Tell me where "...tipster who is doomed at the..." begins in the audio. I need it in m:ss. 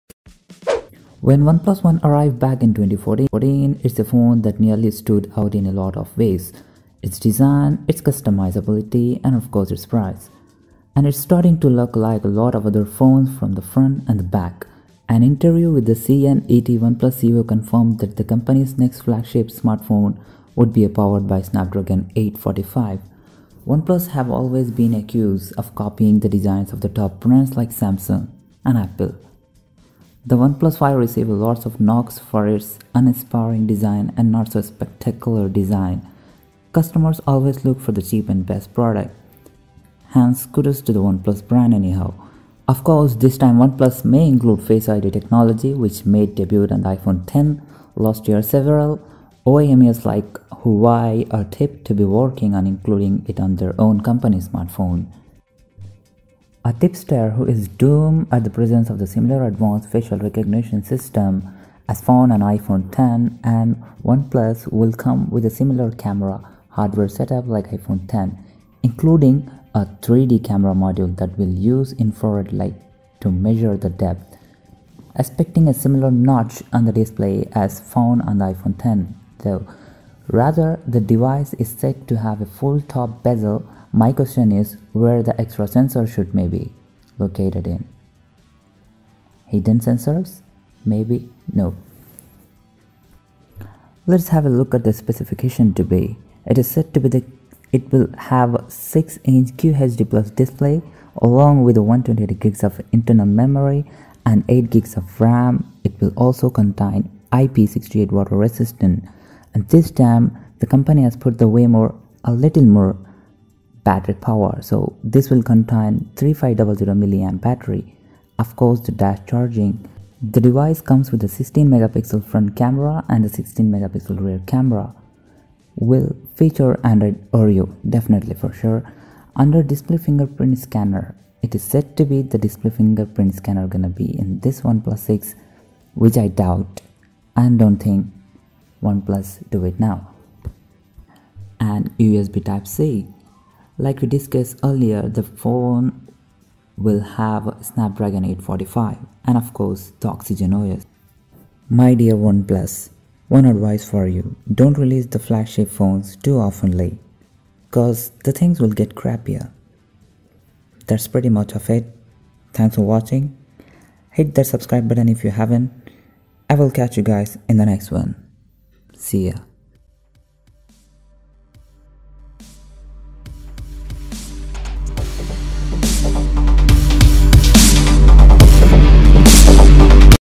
0:56.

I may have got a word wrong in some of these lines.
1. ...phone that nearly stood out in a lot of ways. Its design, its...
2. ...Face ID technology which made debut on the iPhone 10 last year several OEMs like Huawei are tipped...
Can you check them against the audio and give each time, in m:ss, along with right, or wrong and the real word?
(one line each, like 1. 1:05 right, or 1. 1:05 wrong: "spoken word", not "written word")
1. 0:04 right
2. 0:44 right.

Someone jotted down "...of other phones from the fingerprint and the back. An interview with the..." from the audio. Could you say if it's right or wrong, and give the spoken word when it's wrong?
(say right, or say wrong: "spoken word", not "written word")
wrong: "front", not "fingerprint".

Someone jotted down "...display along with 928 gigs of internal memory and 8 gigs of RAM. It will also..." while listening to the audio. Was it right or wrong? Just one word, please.
wrong.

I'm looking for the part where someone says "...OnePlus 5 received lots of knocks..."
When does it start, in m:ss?
0:30.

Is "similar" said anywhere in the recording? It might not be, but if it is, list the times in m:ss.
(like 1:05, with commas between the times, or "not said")
0:59, 1:05, 1:15.